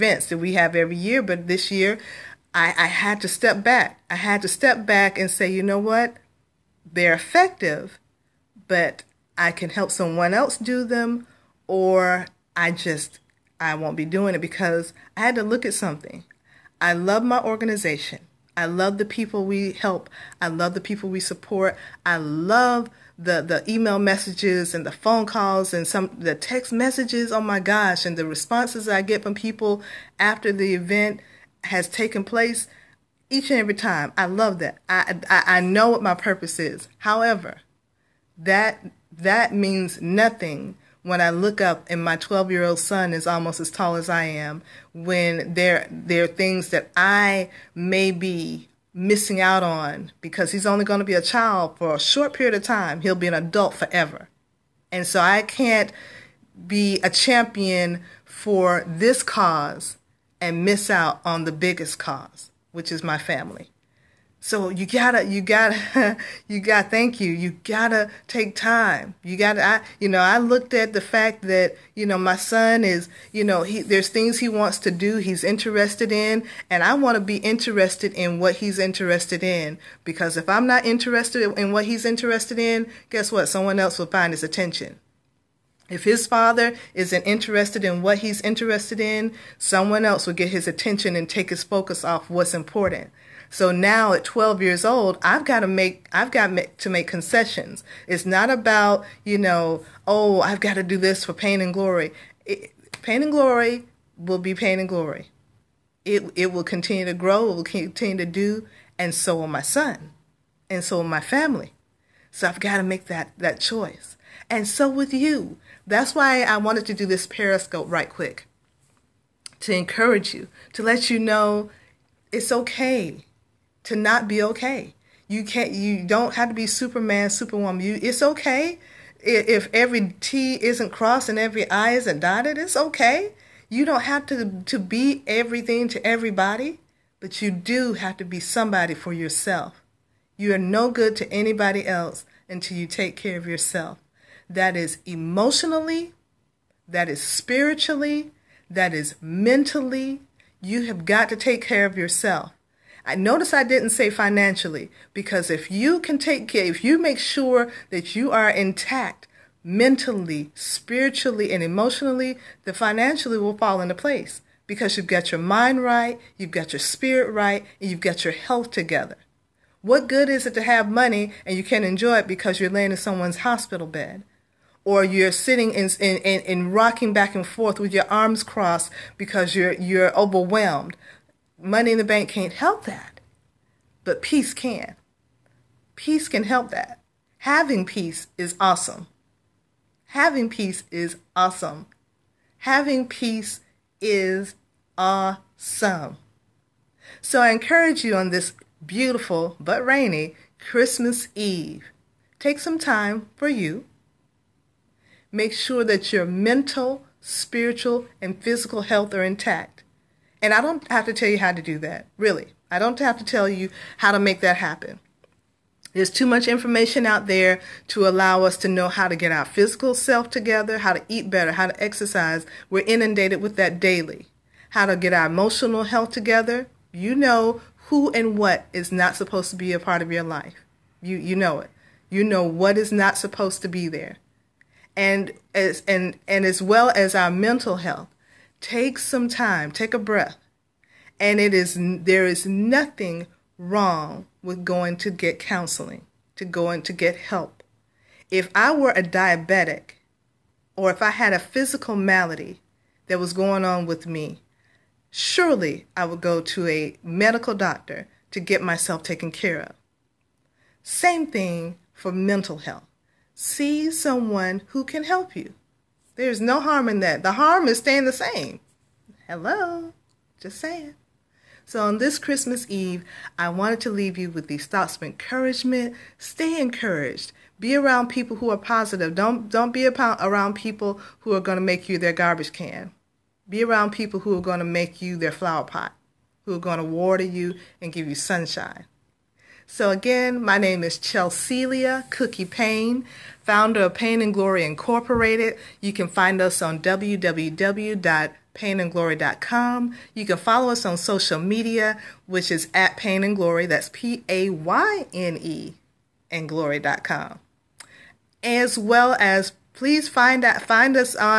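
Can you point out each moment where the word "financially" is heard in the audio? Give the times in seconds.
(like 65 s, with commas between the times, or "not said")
154 s, 162 s.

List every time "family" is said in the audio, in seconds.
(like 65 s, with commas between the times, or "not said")
63 s, 111 s.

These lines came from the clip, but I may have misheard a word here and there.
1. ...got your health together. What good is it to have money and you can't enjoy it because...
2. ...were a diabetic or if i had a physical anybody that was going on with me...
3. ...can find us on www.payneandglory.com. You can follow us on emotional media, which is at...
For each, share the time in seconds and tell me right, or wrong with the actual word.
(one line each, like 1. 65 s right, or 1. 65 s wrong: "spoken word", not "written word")
1. 168 s right
2. 248 s wrong: "malady", not "anybody"
3. 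295 s wrong: "social", not "emotional".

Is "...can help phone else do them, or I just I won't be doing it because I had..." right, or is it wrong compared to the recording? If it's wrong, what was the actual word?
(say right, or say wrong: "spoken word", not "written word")
wrong: "someone", not "phone".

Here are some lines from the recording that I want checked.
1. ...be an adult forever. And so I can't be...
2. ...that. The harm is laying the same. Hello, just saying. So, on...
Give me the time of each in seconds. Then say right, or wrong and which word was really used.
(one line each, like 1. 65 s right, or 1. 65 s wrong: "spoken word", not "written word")
1. 53 s right
2. 267 s wrong: "staying", not "laying".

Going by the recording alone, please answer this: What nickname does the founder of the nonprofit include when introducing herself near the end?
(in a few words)
Cookie.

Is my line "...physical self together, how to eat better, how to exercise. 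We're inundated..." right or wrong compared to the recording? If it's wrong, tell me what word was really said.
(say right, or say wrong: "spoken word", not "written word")
right.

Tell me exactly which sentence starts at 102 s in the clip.
It, Payne and glory will be Payne and glory.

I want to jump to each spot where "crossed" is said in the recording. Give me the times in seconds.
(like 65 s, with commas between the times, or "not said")
130 s, 178 s.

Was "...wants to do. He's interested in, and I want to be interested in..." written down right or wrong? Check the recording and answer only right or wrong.
right.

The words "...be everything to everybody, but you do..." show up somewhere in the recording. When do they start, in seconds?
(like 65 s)
134 s.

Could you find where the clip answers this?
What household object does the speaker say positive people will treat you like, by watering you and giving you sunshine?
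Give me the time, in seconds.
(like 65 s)
285 s.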